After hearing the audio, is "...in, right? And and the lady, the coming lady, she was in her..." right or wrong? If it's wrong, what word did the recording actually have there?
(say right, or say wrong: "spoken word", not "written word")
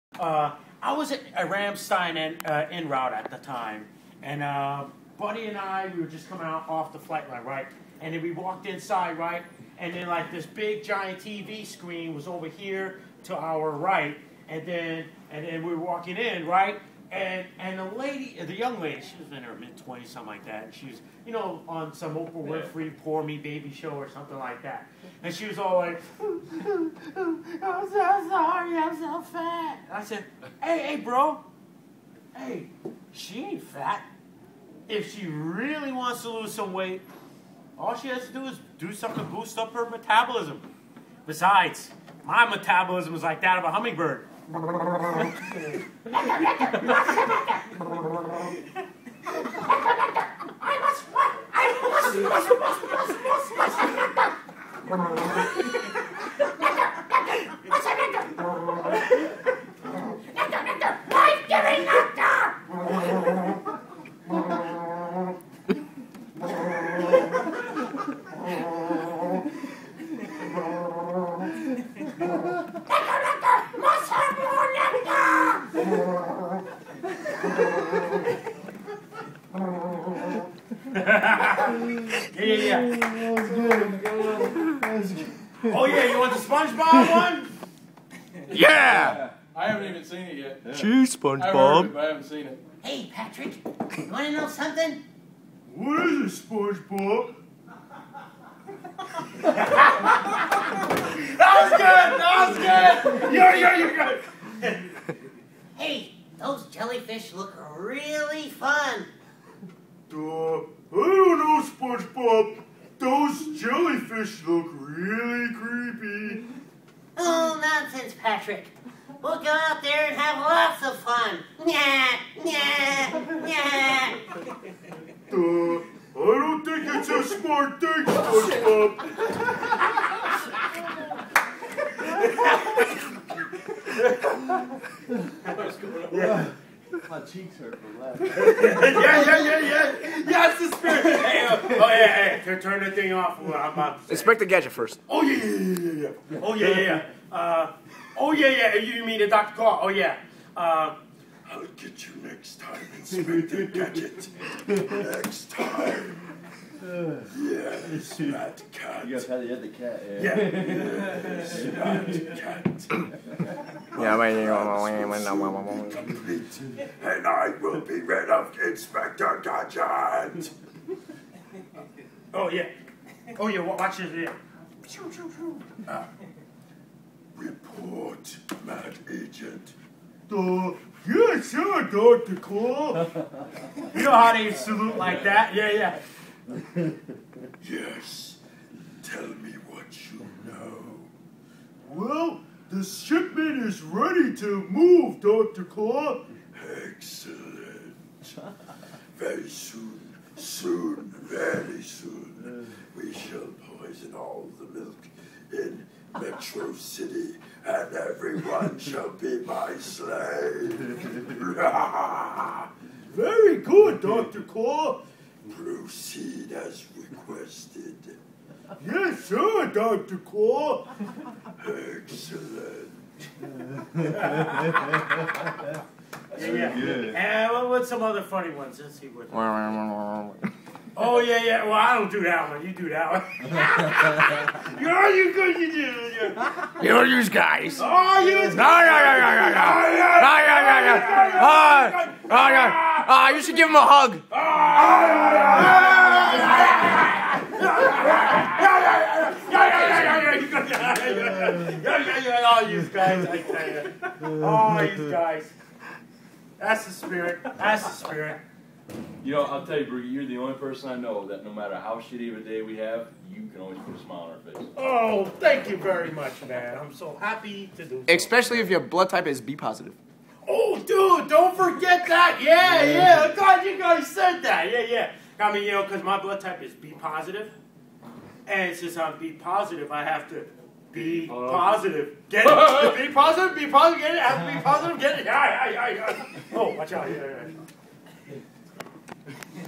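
wrong: "young", not "coming".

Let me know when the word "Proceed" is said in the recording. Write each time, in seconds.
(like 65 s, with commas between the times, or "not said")
215 s.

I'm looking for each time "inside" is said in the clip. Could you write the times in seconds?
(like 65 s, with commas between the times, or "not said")
8 s.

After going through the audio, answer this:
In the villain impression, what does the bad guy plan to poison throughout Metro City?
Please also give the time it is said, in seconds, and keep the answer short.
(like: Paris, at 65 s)
the milk, at 204 s.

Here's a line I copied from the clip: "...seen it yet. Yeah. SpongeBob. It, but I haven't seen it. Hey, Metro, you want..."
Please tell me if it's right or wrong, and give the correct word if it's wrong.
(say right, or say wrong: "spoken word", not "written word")
wrong: "Patrick", not "Metro".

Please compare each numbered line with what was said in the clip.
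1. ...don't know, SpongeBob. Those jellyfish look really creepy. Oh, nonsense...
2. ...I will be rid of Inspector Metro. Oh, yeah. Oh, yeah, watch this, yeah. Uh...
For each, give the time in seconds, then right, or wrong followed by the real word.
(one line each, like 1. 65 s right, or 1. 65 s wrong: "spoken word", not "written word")
1. 110 s right
2. 167 s wrong: "Gadget", not "Metro".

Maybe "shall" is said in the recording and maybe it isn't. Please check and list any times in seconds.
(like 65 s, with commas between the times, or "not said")
203 s, 208 s.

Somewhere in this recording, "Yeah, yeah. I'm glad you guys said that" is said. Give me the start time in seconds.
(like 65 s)
272 s.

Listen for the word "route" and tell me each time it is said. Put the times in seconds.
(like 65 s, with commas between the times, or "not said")
2 s.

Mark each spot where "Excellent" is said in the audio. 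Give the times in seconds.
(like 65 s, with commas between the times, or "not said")
196 s, 221 s.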